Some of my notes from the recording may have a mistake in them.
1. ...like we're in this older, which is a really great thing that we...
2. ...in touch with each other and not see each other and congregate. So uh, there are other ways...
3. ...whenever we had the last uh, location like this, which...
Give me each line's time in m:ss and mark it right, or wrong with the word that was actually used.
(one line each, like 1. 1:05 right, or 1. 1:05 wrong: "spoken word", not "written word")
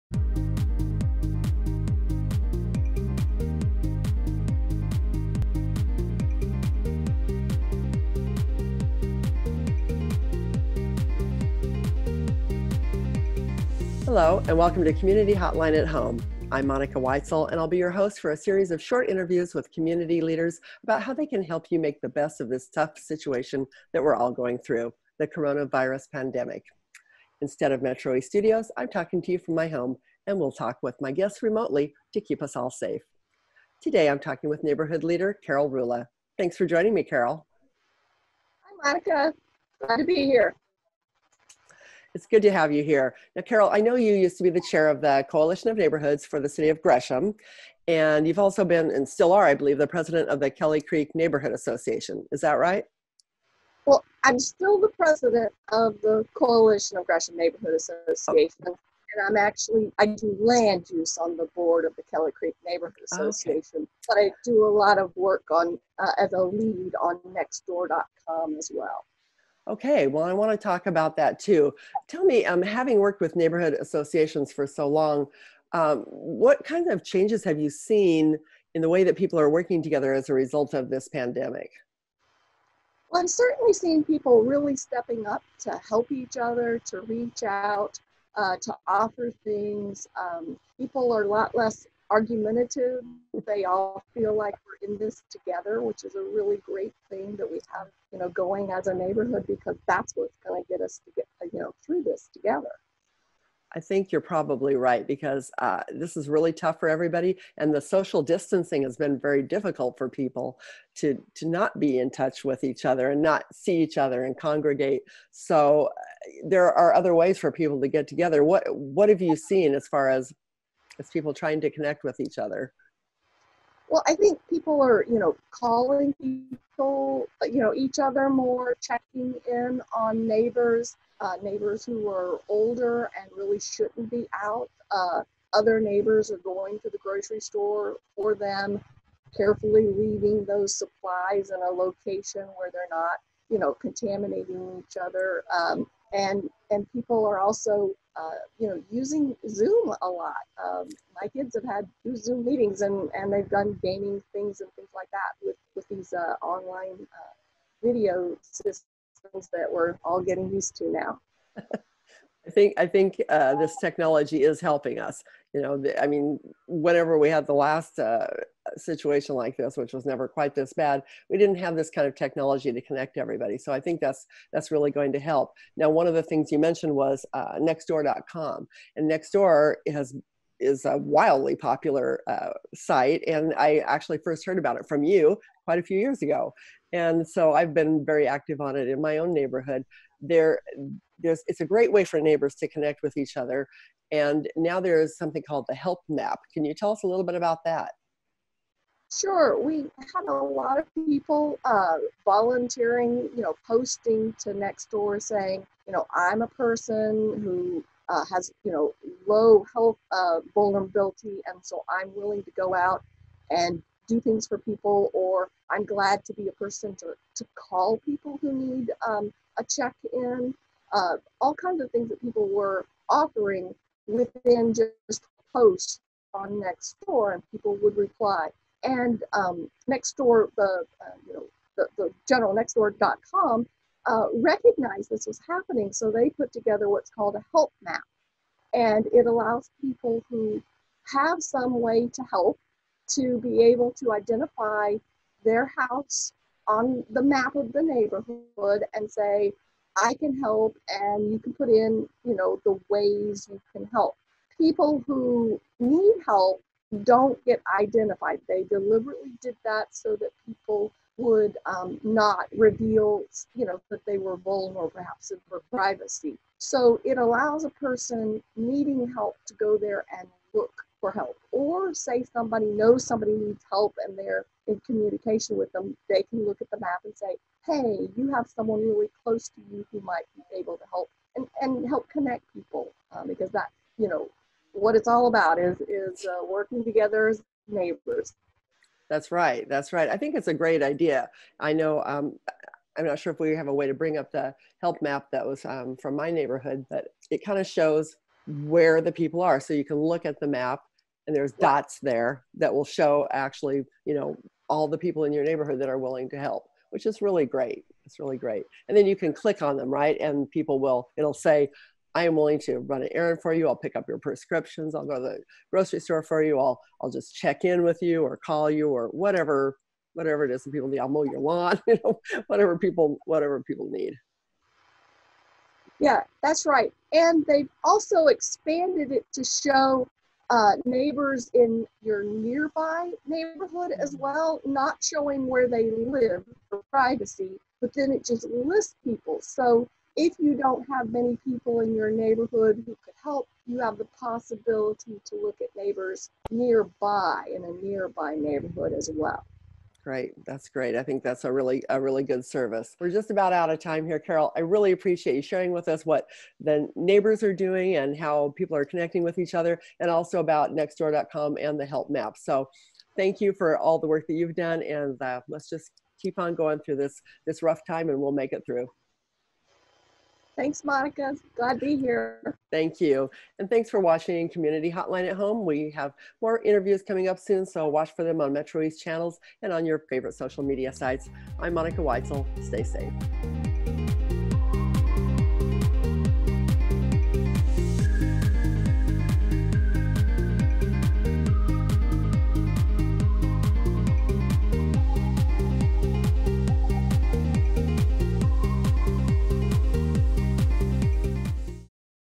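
1. 1:34 wrong: "together", not "older"
2. 1:51 right
3. 2:46 wrong: "situation", not "location".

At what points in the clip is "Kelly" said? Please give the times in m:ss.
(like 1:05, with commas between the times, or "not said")
0:50, 1:02.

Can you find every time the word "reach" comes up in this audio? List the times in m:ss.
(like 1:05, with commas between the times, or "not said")
1:27.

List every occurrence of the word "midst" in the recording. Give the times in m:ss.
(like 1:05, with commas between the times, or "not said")
not said.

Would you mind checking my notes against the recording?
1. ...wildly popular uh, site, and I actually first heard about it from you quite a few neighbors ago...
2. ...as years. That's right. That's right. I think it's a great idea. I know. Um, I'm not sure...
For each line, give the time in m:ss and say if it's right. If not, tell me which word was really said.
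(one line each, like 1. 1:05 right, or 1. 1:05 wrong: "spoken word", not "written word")
1. 3:00 wrong: "years", not "neighbors"
2. 4:47 wrong: "neighbors", not "years".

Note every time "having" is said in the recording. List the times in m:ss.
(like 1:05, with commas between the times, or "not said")
1:12.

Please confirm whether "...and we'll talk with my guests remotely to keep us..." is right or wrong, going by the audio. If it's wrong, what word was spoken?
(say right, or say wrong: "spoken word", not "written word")
right.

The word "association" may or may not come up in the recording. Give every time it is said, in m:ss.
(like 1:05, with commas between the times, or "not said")
0:51, 0:57, 1:03, 1:13.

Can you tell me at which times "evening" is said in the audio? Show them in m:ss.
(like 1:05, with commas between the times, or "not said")
not said.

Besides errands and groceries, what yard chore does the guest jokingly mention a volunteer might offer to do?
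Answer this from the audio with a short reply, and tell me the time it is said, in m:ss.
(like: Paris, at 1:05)
mow your lawn, at 5:21.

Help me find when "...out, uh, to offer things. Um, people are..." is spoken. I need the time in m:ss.
1:27.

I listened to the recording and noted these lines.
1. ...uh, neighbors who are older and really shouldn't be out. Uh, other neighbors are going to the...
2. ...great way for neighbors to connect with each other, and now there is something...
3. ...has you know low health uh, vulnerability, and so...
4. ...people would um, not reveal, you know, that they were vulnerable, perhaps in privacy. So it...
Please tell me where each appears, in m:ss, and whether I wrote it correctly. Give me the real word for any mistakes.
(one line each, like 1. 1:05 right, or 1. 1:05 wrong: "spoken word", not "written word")
1. 2:11 right
2. 3:11 right
3. 3:28 right
4. 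4:20 right.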